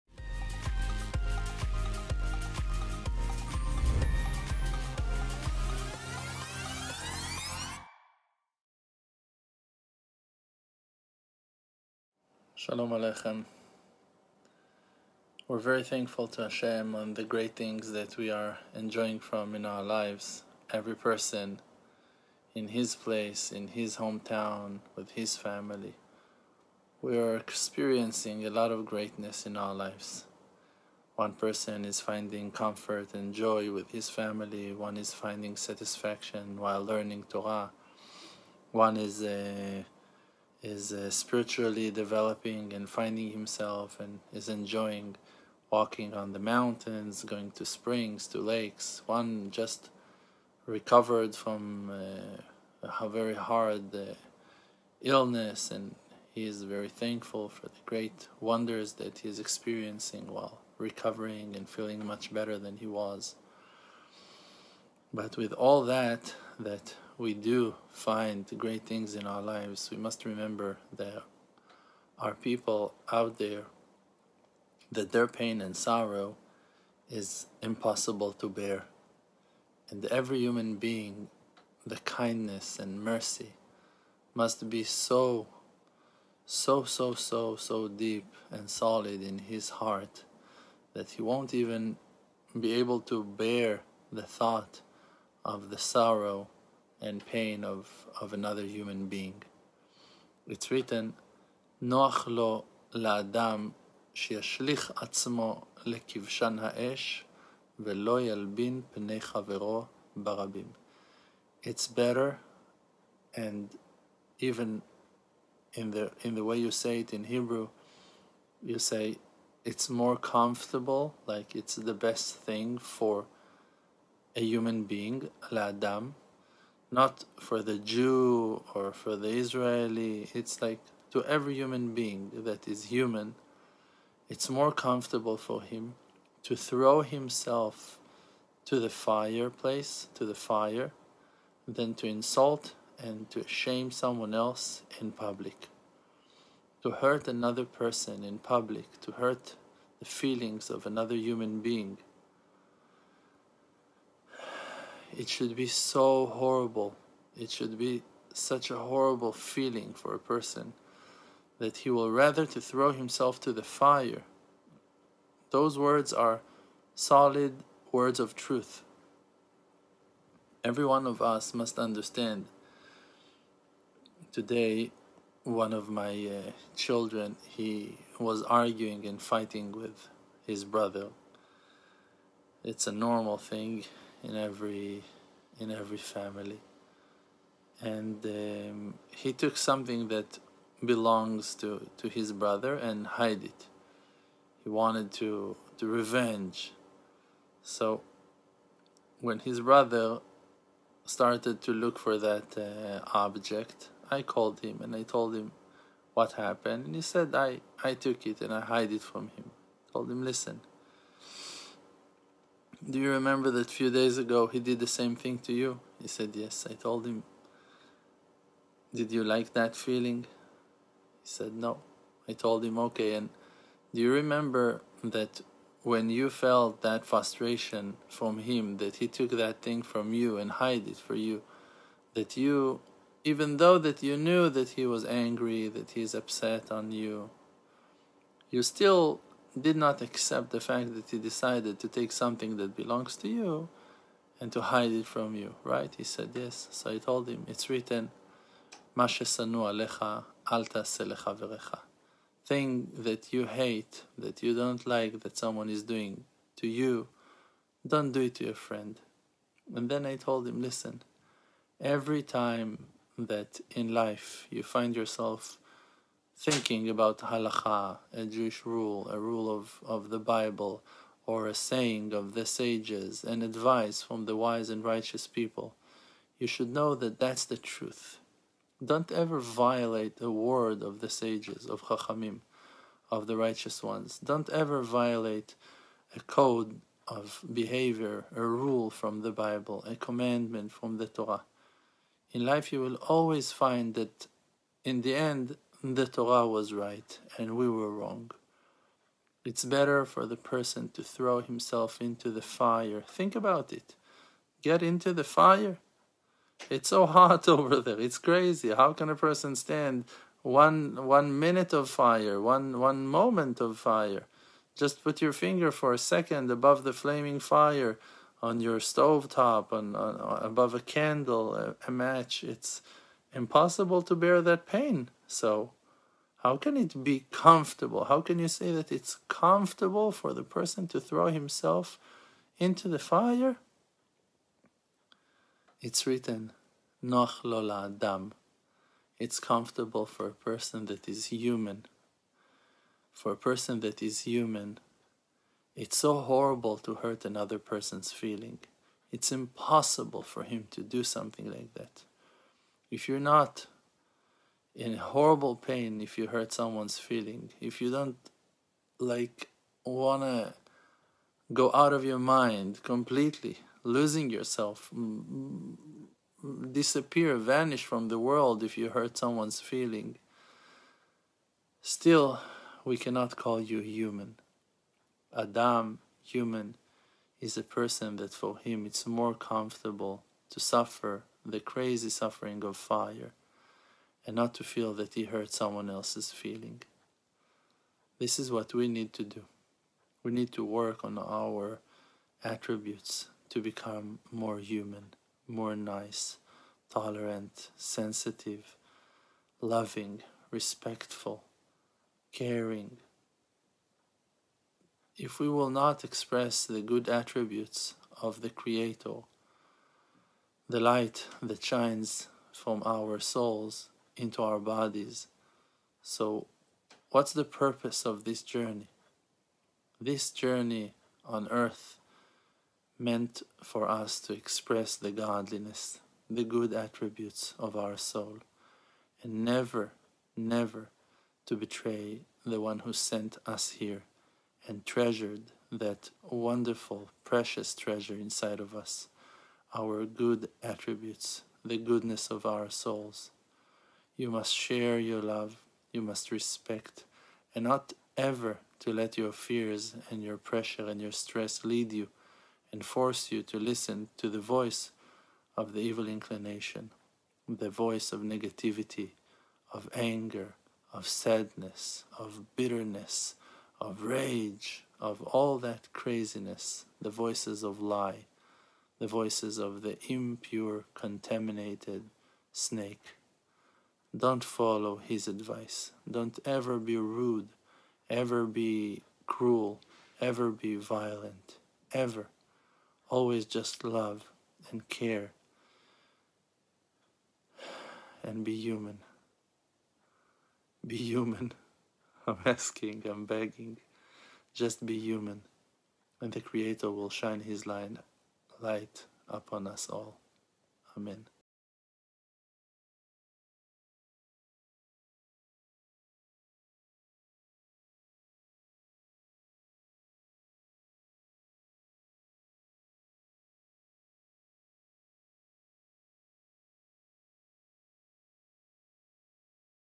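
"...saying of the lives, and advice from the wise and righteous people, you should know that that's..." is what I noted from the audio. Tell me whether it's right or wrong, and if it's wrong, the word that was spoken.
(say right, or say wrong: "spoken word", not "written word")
wrong: "sages", not "lives".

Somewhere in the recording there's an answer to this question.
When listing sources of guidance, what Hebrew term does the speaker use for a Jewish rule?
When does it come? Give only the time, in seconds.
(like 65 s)
267 s.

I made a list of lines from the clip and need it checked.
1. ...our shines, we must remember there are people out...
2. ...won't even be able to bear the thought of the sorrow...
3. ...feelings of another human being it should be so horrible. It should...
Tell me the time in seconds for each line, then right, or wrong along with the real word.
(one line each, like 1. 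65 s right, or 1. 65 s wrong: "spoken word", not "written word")
1. 69 s wrong: "lives", not "shines"
2. 91 s right
3. 150 s right.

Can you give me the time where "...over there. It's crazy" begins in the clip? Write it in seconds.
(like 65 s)
307 s.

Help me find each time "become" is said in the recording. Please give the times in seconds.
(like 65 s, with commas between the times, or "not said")
393 s.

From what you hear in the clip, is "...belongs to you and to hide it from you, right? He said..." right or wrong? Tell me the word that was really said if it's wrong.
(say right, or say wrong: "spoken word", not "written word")
right.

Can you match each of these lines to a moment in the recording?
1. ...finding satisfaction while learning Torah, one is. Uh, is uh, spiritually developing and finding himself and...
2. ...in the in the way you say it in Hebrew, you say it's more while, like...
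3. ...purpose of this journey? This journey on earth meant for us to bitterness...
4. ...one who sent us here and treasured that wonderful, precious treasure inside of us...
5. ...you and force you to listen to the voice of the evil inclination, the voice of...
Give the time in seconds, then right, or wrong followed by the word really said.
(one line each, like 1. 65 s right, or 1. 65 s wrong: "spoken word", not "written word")
1. 35 s right
2. 115 s wrong: "comfortable", not "while"
3. 417 s wrong: "express", not "bitterness"
4. 432 s right
5. 451 s right.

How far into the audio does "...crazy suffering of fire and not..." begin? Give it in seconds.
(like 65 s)
381 s.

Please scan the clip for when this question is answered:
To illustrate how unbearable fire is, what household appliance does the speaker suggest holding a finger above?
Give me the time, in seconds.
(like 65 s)
318 s.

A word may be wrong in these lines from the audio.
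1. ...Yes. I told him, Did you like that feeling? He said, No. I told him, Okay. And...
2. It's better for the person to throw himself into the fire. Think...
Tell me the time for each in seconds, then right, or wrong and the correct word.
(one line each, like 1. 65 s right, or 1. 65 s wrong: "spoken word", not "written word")
1. 216 s right
2. 299 s right.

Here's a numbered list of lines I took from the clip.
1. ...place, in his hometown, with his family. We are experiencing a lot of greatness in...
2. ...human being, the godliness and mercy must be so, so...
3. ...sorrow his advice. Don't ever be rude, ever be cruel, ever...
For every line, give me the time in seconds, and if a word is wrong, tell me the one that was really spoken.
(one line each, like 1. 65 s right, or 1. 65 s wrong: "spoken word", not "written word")
1. 22 s right
2. 80 s wrong: "kindness", not "godliness"
3. 474 s wrong: "follow", not "sorrow".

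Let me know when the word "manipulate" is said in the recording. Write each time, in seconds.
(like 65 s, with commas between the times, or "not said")
not said.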